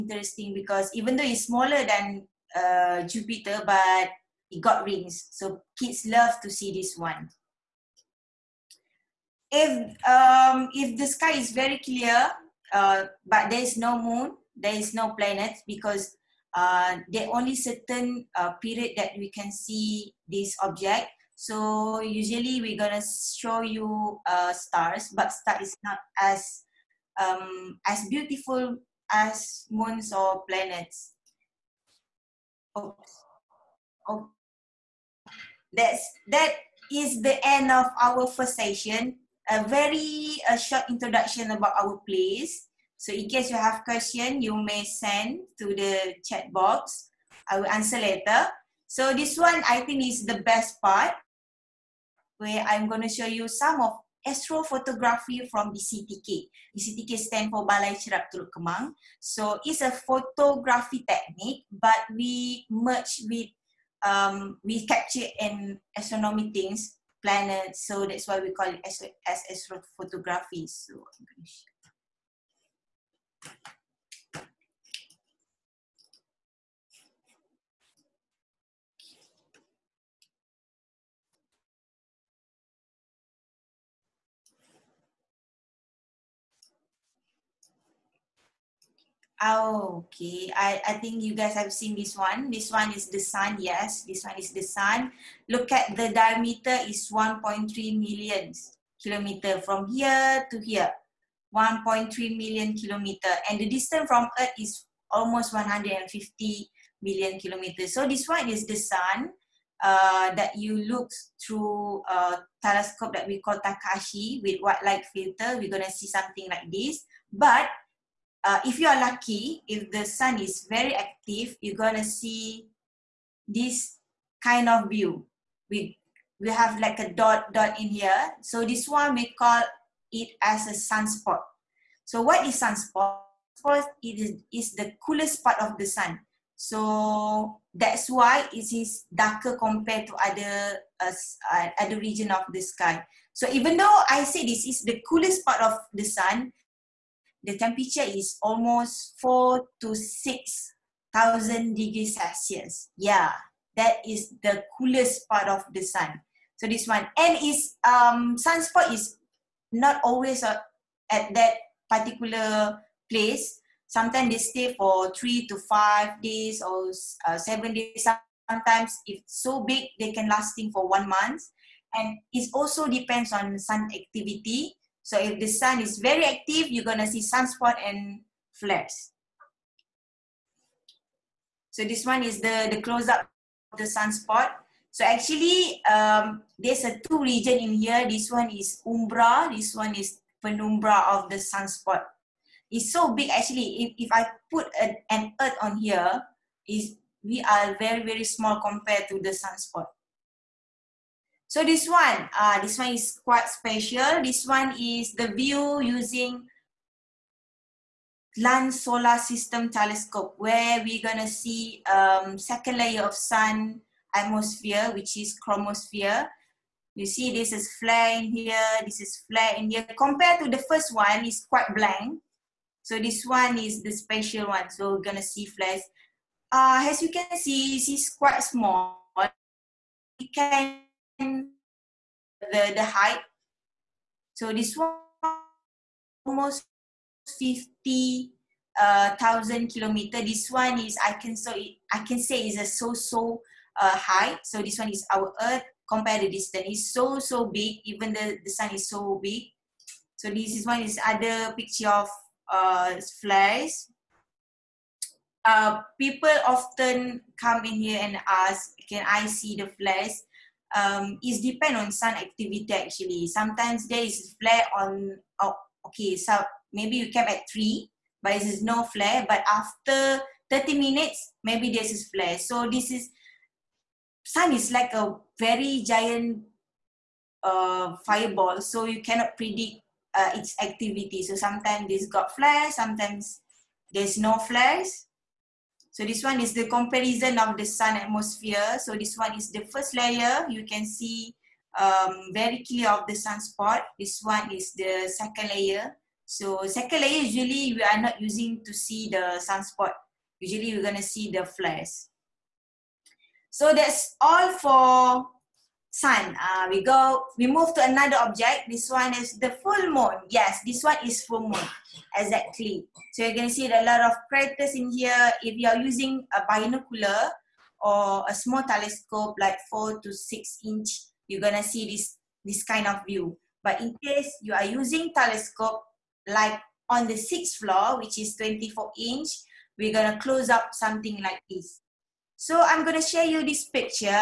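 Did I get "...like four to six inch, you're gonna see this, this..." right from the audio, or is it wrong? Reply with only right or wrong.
right.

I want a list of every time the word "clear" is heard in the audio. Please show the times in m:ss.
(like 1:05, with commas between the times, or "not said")
0:11, 4:52.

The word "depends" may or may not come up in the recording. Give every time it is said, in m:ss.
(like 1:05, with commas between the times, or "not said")
2:52, 4:21.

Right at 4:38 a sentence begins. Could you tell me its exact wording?
So you cannot predict uh, its activity.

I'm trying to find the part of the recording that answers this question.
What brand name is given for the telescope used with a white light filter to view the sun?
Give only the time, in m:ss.
1:53.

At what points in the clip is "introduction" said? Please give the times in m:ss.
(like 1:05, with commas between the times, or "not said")
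0:40.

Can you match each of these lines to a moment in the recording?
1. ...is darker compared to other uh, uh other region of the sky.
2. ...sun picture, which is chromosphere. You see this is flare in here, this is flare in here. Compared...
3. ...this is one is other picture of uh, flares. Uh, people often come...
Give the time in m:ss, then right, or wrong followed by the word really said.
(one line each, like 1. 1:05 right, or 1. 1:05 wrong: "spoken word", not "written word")
1. 2:18 right
2. 3:33 wrong: "atmosphere", not "picture"
3. 4:10 right.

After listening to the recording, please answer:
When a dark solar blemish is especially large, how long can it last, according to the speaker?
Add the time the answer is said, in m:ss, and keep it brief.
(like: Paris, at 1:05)
1 month, at 2:50.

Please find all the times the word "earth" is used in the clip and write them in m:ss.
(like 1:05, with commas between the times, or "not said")
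1:44, 3:15, 4:05.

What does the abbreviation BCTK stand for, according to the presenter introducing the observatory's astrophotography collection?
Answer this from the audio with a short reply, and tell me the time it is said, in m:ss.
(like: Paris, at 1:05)
Balai Cerap Teluk Kemang, at 0:57.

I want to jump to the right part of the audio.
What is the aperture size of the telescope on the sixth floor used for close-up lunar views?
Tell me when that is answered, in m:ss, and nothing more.
5:28.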